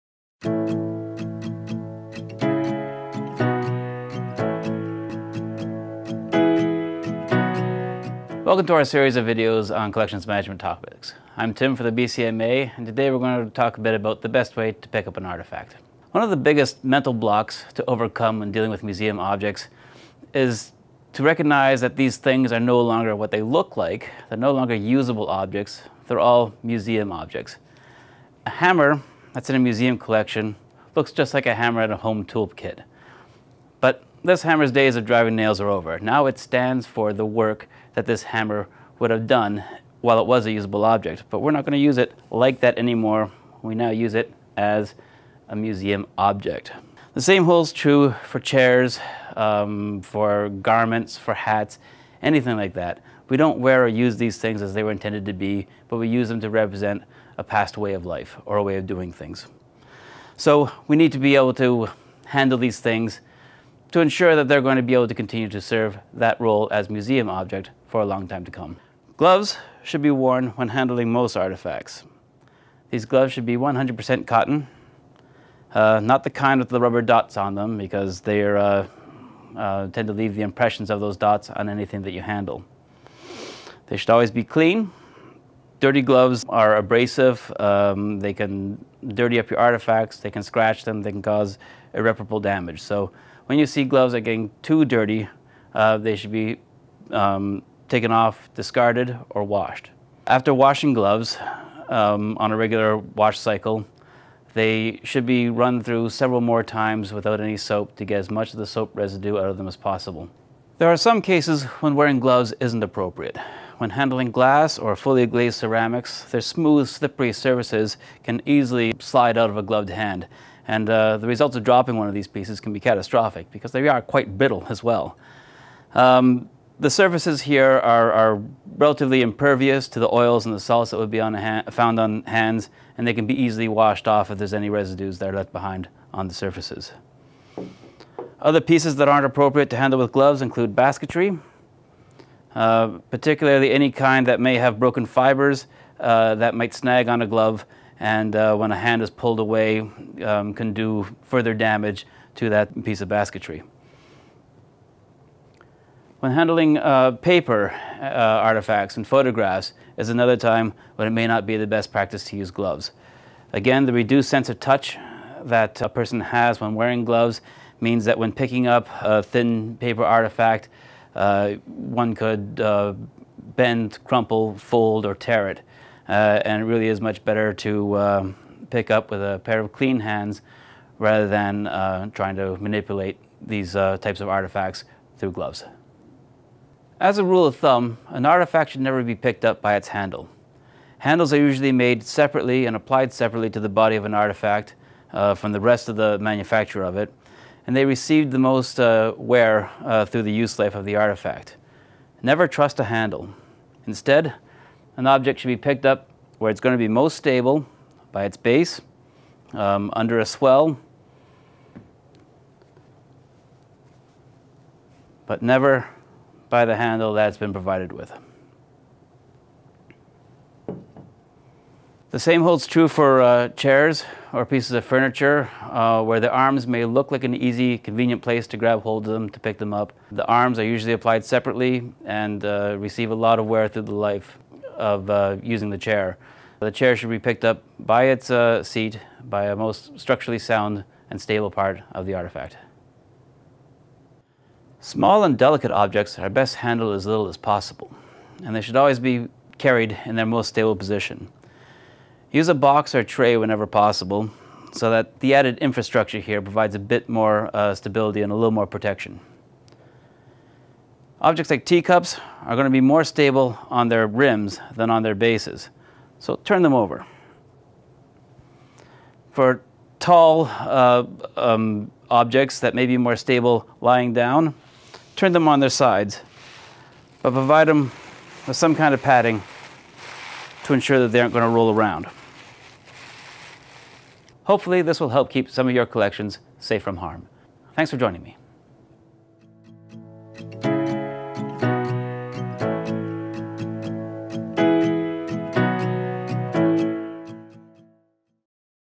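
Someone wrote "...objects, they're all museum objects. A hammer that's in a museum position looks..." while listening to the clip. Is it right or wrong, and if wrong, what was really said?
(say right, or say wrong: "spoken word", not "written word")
wrong: "collection", not "position".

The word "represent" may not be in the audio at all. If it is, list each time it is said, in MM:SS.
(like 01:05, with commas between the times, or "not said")
00:56.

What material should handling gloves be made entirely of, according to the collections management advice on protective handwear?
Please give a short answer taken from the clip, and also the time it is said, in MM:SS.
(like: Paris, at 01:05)
100% cotton, at 01:13.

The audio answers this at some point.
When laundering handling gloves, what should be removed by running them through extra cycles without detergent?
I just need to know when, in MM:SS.
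01:48.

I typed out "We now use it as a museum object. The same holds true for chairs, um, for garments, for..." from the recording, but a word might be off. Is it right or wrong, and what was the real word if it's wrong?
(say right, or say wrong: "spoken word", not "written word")
right.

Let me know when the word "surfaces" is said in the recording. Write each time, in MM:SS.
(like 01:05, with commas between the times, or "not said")
01:57, 02:06, 02:16.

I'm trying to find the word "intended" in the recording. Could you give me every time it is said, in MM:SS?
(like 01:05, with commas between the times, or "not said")
00:54.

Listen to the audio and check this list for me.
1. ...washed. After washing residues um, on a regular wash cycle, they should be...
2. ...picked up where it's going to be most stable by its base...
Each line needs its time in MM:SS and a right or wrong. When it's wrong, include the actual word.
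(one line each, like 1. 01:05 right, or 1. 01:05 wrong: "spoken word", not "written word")
1. 01:39 wrong: "gloves", not "residues"
2. 03:25 right.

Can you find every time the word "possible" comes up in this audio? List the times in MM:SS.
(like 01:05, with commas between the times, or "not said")
01:49, 04:07, 04:13.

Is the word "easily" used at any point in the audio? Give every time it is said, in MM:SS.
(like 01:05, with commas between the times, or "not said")
01:58, 02:13.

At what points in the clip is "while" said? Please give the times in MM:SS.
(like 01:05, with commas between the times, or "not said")
00:40.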